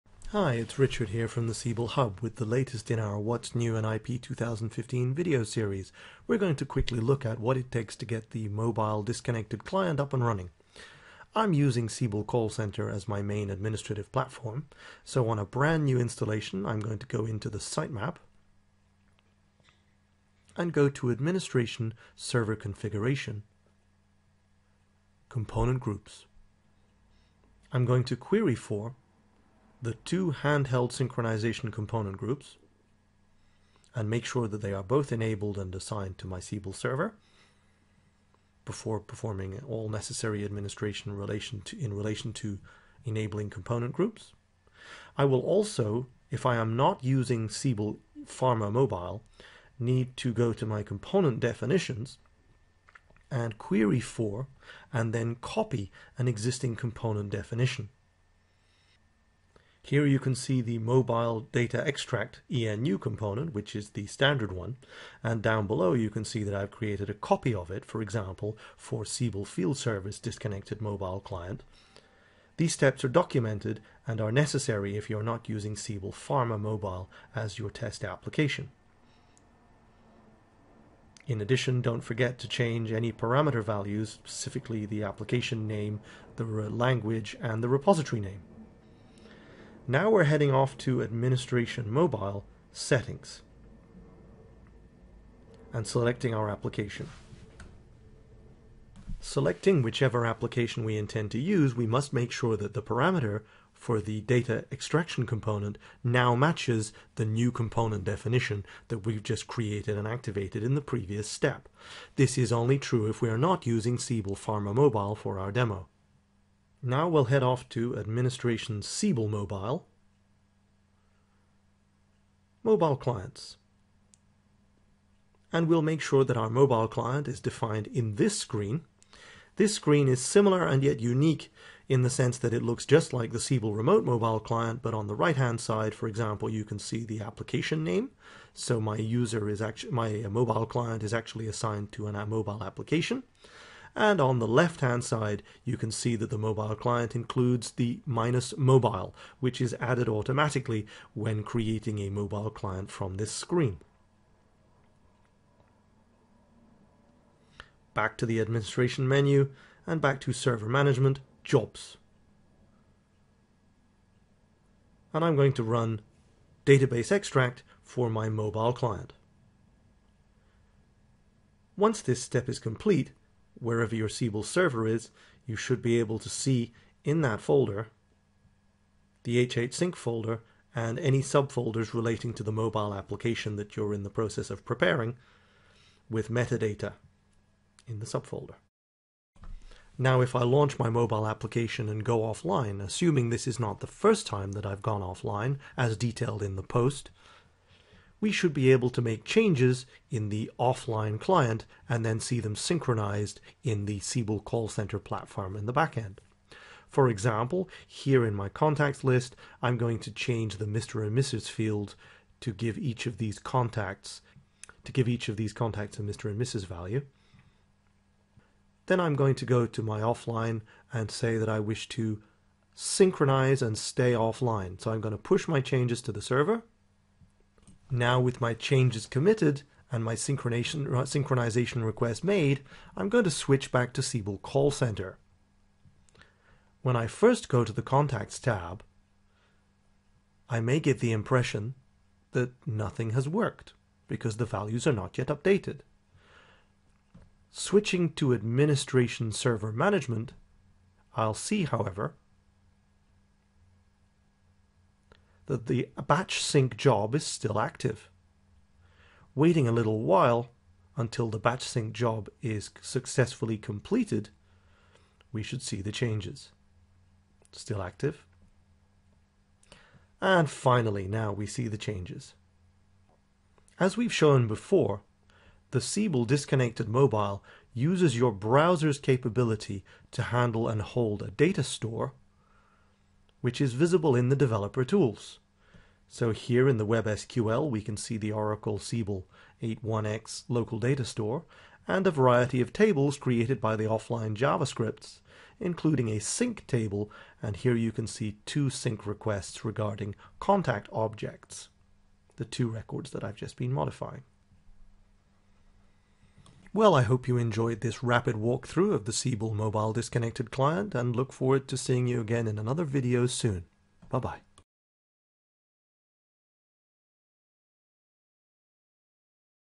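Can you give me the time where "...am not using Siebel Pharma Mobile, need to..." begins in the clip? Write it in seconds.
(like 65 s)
46 s.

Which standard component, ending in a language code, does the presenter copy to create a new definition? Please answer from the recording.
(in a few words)
Mobile Data Extract ENU.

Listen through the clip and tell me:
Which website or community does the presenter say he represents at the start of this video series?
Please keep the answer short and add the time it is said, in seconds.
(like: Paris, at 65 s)
Siebel Hub, at 1 s.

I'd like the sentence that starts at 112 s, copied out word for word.
This is only true if we are not using Siebel Pharma Mobile for our demo.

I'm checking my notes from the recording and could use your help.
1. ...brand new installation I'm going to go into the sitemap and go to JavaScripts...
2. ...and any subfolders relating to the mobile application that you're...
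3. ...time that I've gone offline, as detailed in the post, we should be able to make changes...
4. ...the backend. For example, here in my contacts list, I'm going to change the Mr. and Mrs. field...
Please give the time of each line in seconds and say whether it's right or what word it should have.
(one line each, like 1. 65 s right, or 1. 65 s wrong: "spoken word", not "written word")
1. 15 s wrong: "Administration", not "JavaScripts"
2. 180 s right
3. 194 s right
4. 205 s right.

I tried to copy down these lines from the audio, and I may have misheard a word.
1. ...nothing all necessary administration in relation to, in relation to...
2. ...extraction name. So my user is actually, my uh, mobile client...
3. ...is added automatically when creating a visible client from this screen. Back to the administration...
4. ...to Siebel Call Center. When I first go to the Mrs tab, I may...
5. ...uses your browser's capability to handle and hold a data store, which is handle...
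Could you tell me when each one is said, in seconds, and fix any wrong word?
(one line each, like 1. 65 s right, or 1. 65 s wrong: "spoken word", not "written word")
1. 38 s wrong: "performing", not "nothing"
2. 137 s wrong: "application", not "extraction"
3. 149 s wrong: "mobile", not "visible"
4. 233 s wrong: "Contacts", not "Mrs"
5. 277 s wrong: "visible", not "handle".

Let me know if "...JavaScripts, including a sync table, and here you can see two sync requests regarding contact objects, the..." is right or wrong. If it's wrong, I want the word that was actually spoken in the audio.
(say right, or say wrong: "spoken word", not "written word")
right.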